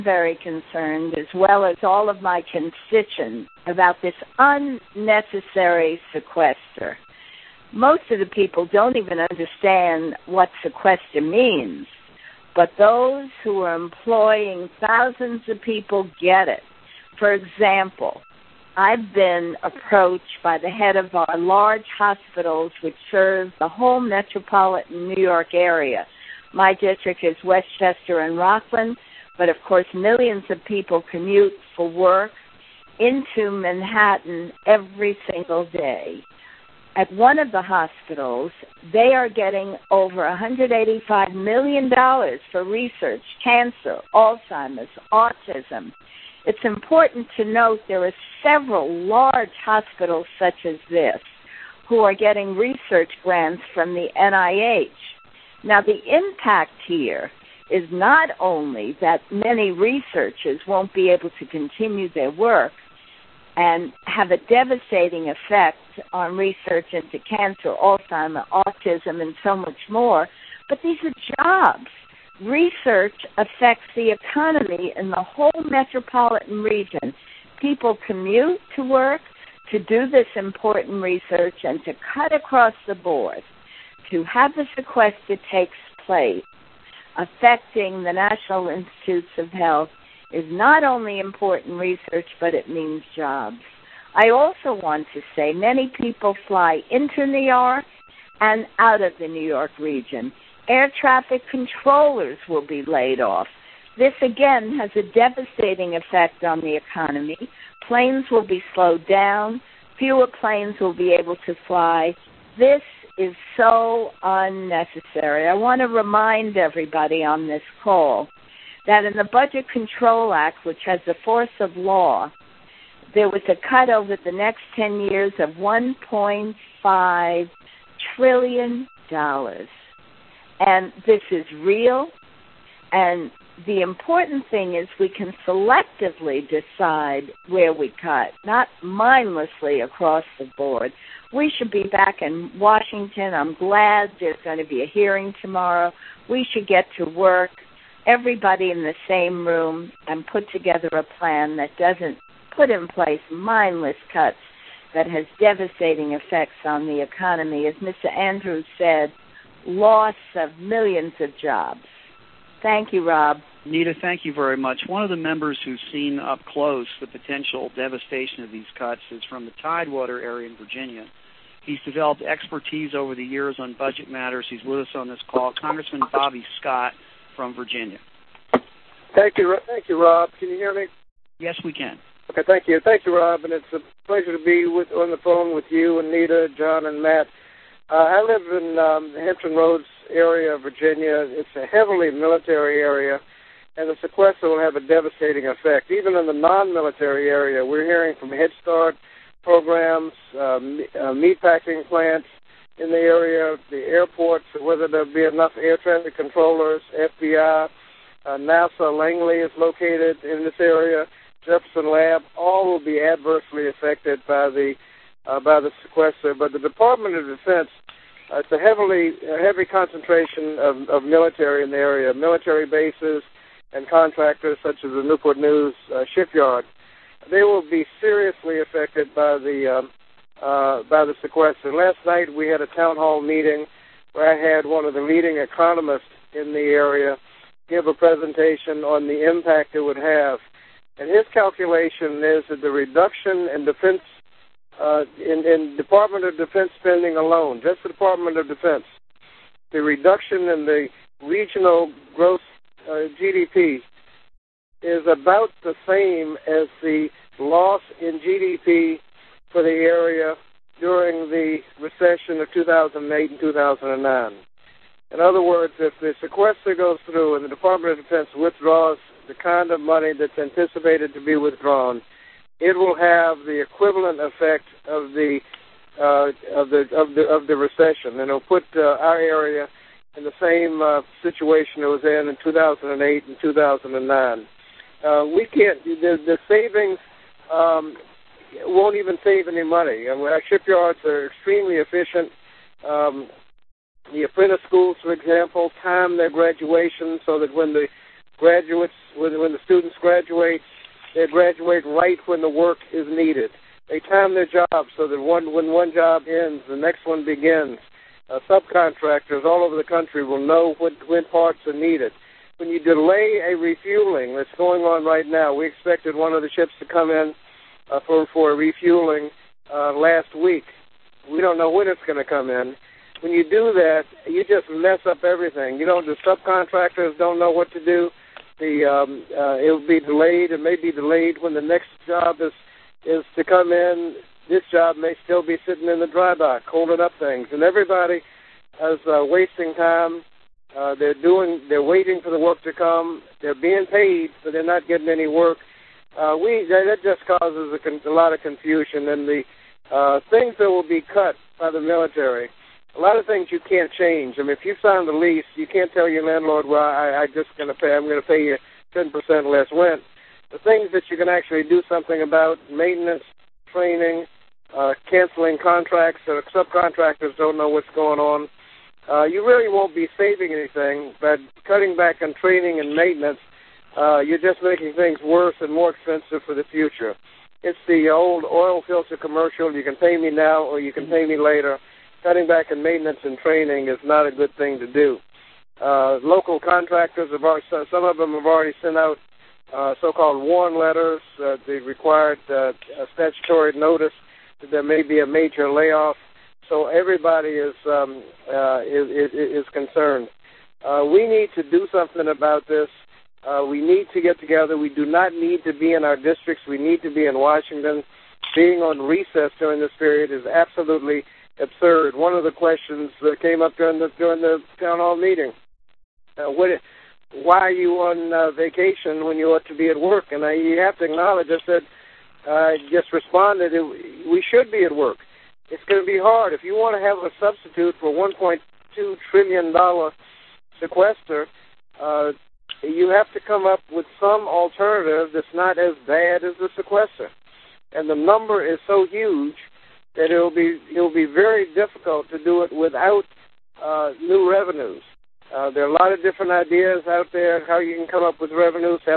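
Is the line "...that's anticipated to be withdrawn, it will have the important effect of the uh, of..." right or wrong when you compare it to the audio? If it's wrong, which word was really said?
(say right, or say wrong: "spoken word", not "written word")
wrong: "equivalent", not "important".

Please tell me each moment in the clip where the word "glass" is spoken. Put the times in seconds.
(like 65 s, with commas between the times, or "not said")
not said.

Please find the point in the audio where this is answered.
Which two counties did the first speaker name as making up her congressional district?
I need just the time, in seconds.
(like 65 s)
27 s.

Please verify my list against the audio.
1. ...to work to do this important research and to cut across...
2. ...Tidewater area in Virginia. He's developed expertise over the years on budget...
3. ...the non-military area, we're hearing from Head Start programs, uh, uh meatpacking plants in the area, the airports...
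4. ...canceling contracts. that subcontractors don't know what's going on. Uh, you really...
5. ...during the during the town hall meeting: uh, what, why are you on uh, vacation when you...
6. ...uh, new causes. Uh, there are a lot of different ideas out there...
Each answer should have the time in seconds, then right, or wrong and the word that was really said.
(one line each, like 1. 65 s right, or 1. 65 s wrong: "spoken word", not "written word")
1. 78 s right
2. 169 s right
3. 196 s right
4. 365 s right
5. 413 s right
6. 443 s wrong: "revenues", not "causes".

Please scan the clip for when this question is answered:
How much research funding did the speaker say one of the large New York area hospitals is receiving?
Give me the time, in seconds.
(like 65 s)
40 s.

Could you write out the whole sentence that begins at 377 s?
It's the old oil filter commercial.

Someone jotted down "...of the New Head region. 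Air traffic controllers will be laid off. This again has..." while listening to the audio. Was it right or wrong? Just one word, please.
wrong.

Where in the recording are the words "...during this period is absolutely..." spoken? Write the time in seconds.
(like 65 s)
409 s.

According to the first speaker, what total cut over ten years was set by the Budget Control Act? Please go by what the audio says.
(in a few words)
$1.5 trillion.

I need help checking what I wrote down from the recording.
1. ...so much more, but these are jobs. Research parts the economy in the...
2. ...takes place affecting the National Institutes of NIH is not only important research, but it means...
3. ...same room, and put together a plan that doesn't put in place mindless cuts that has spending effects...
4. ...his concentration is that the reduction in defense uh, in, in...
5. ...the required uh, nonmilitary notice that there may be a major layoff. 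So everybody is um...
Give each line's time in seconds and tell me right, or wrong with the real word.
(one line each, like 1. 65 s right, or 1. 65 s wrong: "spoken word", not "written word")
1. 69 s wrong: "affects", not "parts"
2. 85 s wrong: "Health", not "NIH"
3. 149 s wrong: "devastating", not "spending"
4. 241 s wrong: "calculation", not "concentration"
5. 391 s wrong: "statutory", not "nonmilitary".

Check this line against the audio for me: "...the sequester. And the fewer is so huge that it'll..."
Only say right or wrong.
wrong.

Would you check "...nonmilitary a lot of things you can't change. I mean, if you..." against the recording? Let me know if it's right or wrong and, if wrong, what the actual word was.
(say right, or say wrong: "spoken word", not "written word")
wrong: "military", not "nonmilitary".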